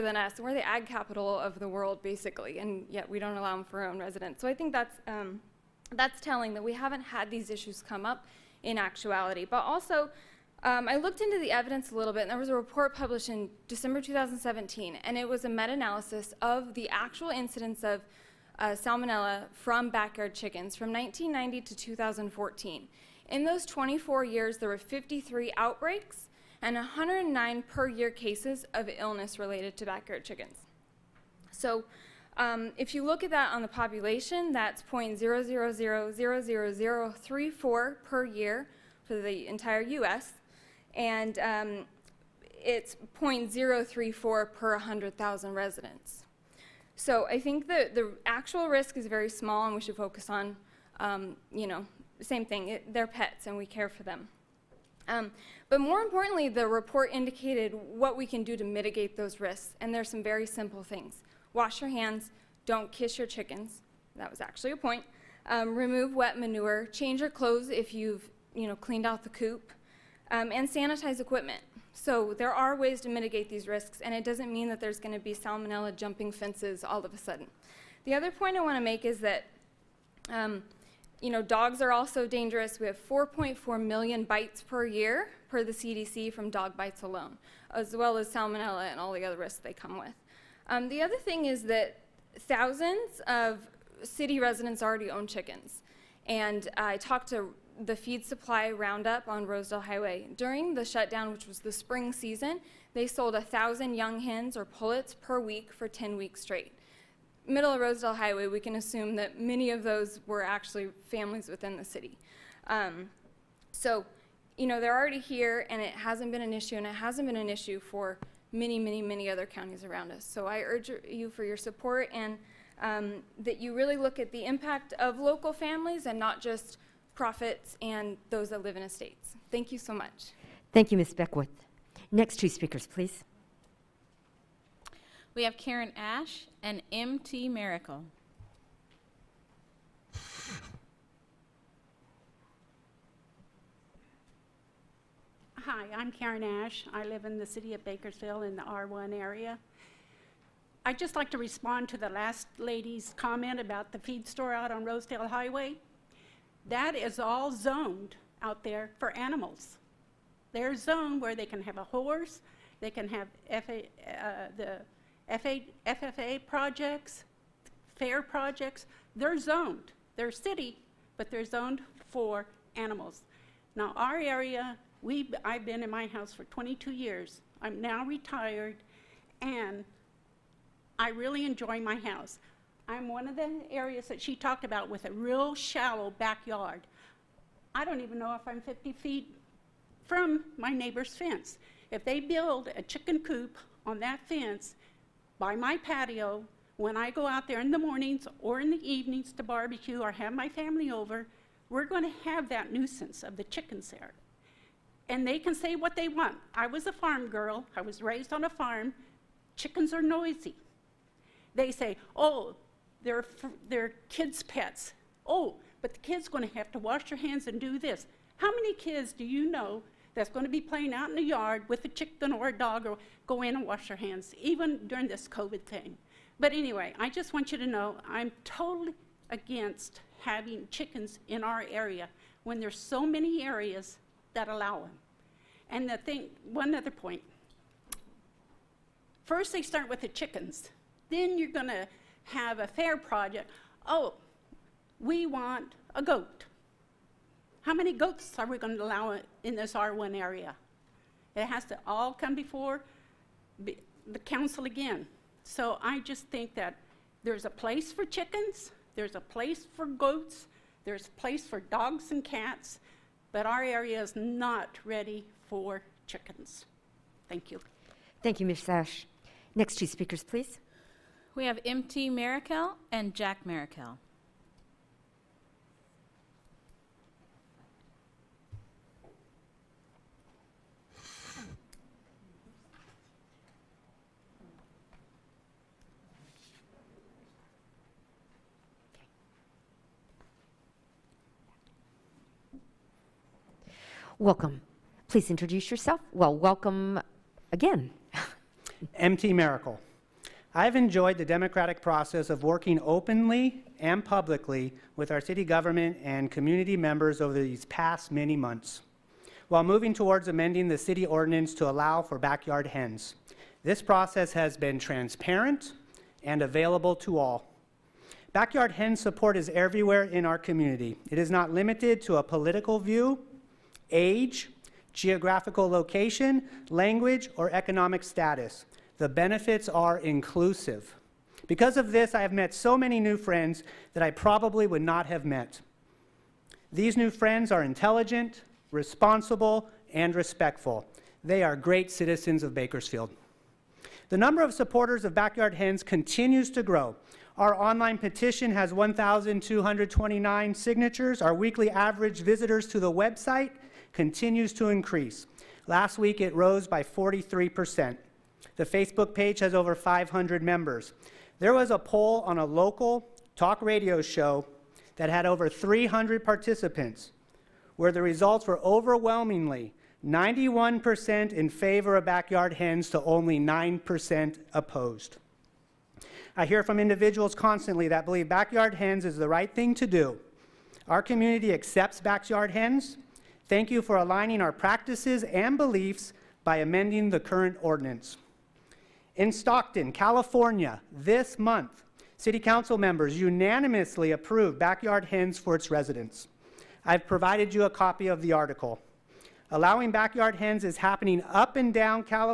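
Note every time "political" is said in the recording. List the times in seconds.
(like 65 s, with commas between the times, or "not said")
322 s.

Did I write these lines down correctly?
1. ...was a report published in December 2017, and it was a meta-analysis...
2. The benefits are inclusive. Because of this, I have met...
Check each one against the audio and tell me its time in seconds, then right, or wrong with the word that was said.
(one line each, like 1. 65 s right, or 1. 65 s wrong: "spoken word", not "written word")
1. 12 s right
2. 328 s right.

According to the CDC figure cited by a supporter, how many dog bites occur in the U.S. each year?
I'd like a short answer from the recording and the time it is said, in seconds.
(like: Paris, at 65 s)
4.4 million, at 83 s.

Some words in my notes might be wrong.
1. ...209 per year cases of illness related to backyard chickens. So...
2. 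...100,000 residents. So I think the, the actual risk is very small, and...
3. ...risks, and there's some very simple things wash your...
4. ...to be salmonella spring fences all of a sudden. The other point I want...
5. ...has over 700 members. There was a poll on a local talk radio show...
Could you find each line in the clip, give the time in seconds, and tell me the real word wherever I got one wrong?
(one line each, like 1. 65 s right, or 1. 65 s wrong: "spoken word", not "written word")
1. 26 s wrong: "109", not "209"
2. 44 s right
3. 59 s right
4. 75 s wrong: "jumping", not "spring"
5. 359 s wrong: "500", not "700".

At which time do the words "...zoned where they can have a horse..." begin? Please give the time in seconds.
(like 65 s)
160 s.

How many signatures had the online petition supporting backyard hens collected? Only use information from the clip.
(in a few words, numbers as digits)
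1,229.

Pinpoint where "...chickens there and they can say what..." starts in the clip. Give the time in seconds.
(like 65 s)
203 s.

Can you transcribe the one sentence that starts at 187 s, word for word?
I don't even know if I'm 50 feet from my neighbor's fence.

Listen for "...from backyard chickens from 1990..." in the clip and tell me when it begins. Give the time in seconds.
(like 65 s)
19 s.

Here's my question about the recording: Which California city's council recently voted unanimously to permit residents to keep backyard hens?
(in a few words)
Stockton.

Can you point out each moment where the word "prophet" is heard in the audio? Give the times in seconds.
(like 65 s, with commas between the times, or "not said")
not said.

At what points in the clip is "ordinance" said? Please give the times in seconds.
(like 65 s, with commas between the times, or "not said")
311 s, 387 s.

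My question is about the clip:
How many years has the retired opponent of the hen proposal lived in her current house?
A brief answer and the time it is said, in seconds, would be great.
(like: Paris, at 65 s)
22, at 176 s.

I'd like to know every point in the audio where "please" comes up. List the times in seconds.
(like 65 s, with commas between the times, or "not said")
132 s, 270 s, 295 s.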